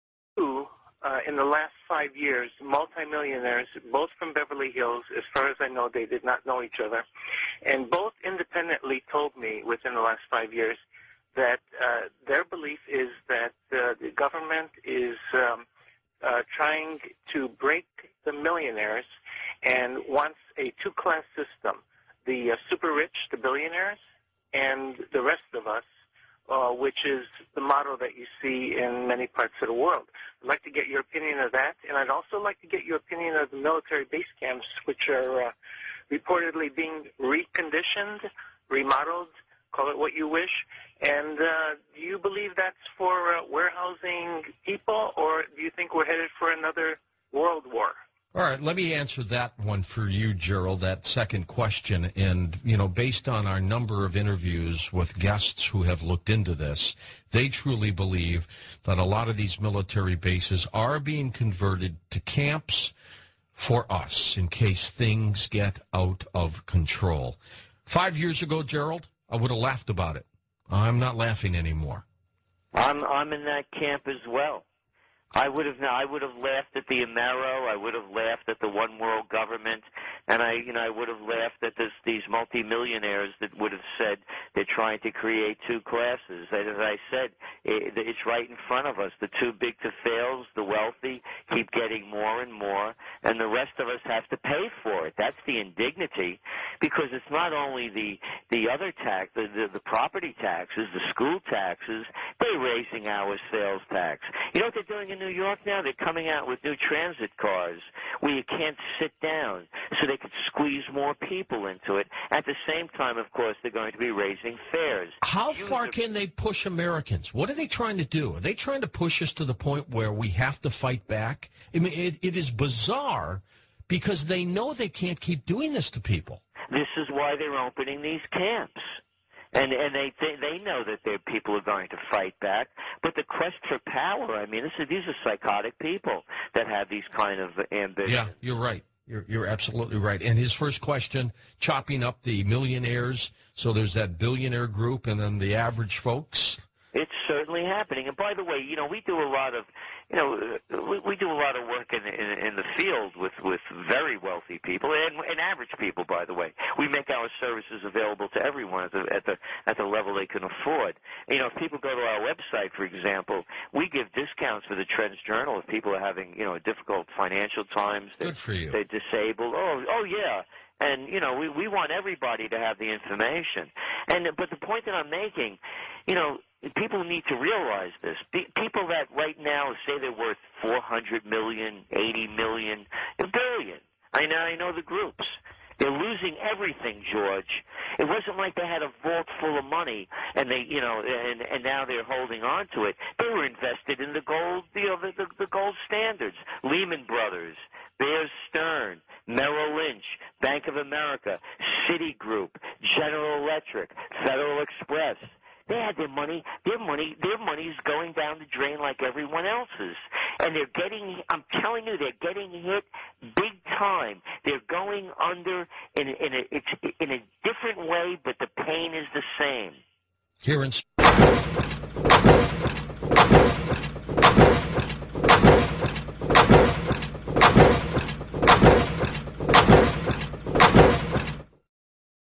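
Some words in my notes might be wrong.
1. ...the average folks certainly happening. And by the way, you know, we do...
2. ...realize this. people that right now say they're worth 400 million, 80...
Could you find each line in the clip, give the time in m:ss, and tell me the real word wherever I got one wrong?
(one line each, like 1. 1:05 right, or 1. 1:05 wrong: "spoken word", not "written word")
1. 2:25 right
2. 2:57 right.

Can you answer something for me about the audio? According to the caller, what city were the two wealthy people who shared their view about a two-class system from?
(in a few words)
Beverly Hills.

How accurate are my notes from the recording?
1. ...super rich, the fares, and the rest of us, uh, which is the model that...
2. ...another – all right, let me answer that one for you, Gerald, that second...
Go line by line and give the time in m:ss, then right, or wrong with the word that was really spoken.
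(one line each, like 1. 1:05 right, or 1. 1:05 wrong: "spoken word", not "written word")
1. 0:22 wrong: "billionaires", not "fares"
2. 0:46 right.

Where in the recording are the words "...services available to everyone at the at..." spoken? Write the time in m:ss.
2:37.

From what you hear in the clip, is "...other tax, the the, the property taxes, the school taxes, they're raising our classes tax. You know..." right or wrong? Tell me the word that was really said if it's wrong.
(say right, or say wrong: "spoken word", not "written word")
wrong: "sales", not "classes".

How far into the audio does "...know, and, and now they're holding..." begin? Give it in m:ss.
3:10.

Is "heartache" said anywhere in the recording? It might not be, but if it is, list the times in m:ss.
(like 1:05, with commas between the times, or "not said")
not said.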